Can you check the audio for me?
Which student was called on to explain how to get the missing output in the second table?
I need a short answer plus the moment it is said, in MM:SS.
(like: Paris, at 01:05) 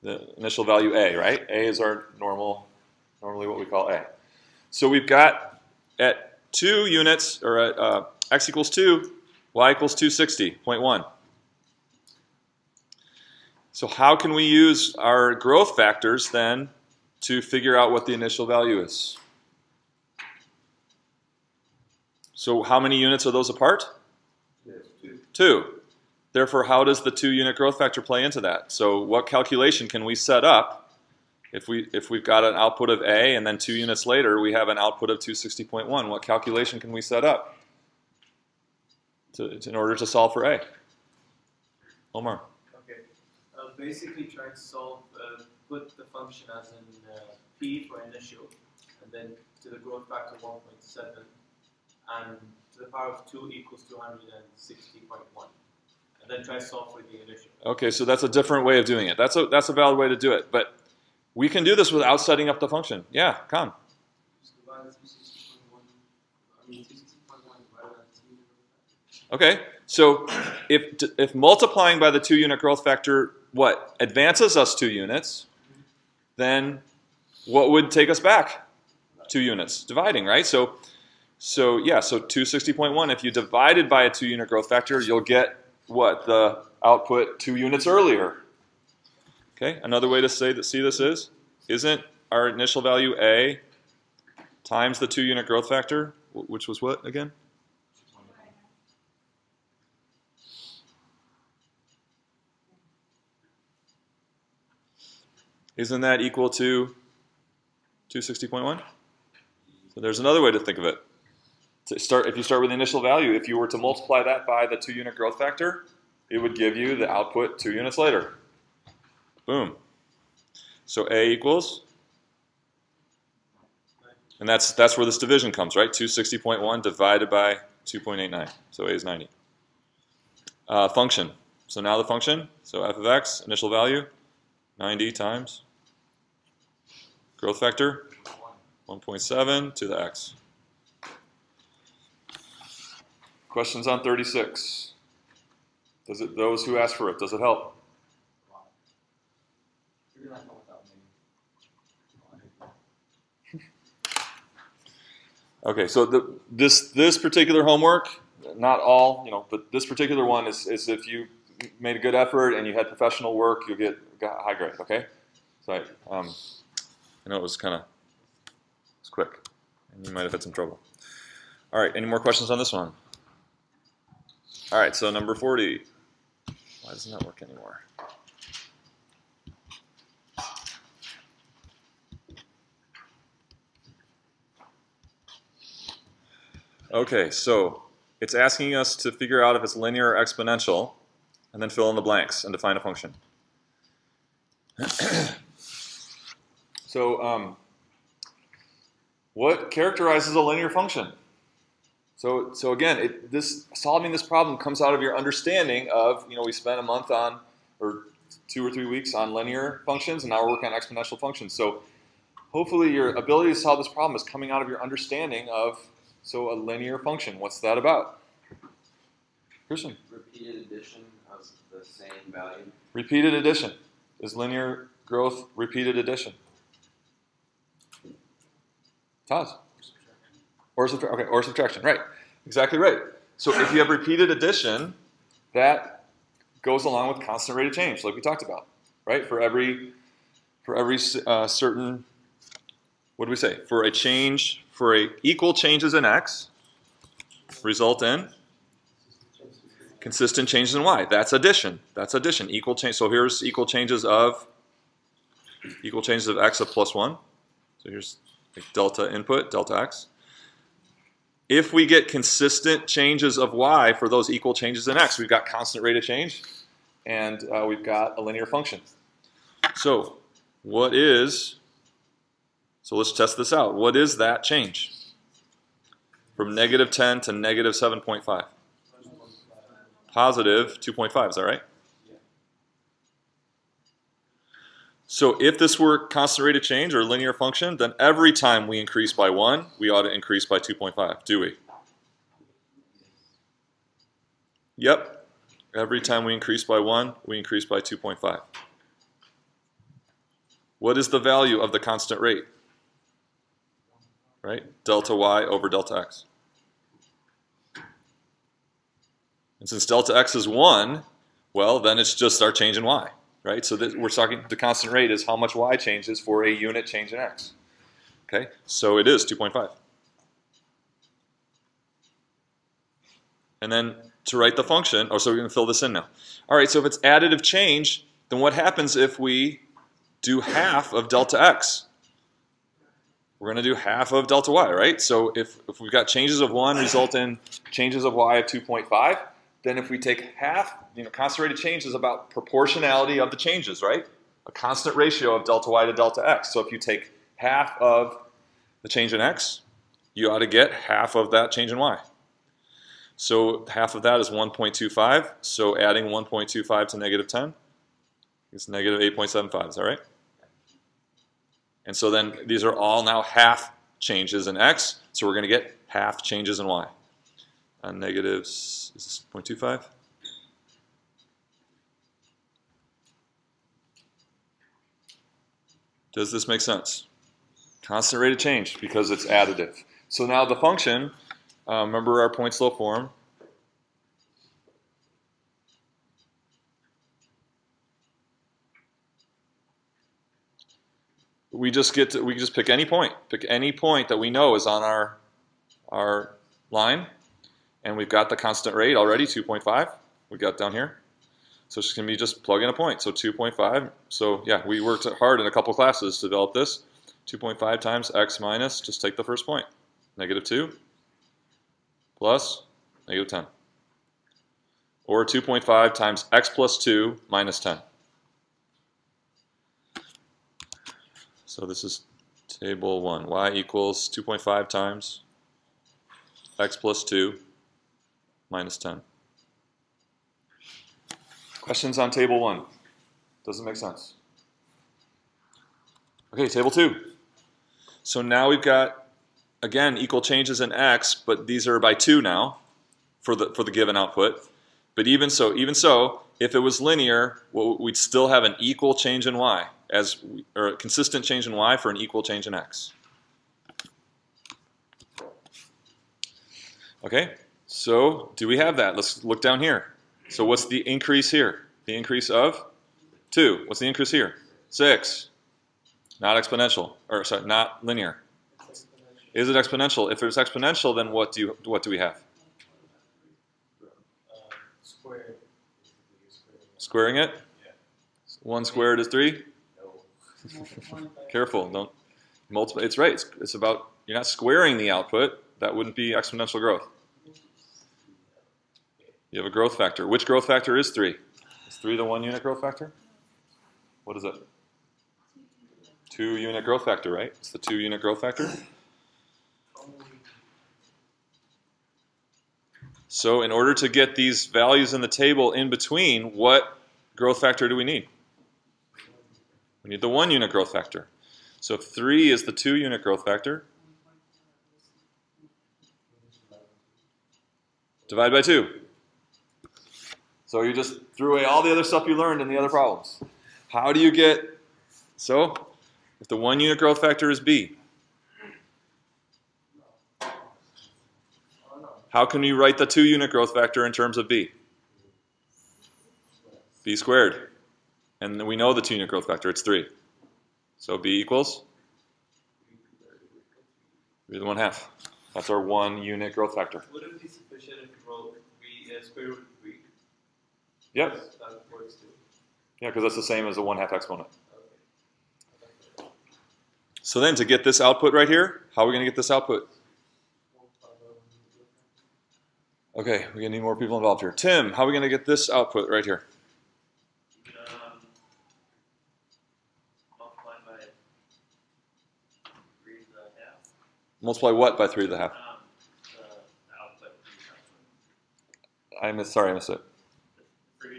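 Tim, at 09:24.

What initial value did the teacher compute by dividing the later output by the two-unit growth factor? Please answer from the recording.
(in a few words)
90.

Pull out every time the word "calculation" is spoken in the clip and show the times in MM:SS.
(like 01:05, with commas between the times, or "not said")
00:29, 00:36.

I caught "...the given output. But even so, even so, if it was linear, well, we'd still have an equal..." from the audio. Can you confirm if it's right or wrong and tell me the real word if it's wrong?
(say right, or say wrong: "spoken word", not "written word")
right.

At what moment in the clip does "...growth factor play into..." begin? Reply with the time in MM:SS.
00:27.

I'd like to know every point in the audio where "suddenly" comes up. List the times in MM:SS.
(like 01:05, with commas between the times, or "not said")
not said.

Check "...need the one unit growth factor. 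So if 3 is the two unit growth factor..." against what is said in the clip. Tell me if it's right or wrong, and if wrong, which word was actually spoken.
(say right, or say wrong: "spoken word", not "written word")
right.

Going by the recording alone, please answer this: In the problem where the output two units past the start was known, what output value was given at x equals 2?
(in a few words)
260.1.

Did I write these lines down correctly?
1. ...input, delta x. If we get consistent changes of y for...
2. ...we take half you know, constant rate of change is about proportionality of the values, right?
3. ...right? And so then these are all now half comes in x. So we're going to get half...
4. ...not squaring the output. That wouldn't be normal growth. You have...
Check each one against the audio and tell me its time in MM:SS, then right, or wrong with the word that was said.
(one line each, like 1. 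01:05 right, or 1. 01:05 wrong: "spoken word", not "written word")
1. 04:19 right
2. 05:39 wrong: "changes", not "values"
3. 05:59 wrong: "changes", not "comes"
4. 08:04 wrong: "exponential", not "normal".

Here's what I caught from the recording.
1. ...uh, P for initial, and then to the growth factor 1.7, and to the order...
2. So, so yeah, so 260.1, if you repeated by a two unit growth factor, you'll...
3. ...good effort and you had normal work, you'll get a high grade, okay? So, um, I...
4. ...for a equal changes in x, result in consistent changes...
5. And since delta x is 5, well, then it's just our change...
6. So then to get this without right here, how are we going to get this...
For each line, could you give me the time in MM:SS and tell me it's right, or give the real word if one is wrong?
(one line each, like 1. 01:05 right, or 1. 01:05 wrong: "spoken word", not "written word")
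1. 00:47 wrong: "power", not "order"
2. 01:20 wrong: "divided", not "repeated"
3. 02:41 wrong: "professional", not "normal"
4. 04:04 right
5. 05:09 wrong: "1", not "5"
6. 09:17 wrong: "output", not "without".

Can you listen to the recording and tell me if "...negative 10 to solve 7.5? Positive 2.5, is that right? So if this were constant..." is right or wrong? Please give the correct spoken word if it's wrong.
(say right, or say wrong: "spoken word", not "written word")
wrong: "negative", not "solve".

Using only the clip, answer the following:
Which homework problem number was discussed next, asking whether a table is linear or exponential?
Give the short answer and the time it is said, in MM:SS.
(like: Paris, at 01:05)
40, at 02:55.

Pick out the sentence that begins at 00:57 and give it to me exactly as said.
Okay, so that's a different way of doing it.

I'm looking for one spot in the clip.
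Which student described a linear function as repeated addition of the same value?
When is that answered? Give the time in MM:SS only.
03:39.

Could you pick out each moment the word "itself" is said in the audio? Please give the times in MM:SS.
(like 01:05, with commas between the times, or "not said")
not said.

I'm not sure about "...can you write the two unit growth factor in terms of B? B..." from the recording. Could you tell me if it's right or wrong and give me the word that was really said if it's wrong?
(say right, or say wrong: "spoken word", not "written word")
right.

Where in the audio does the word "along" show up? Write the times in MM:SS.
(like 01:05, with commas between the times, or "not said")
03:56.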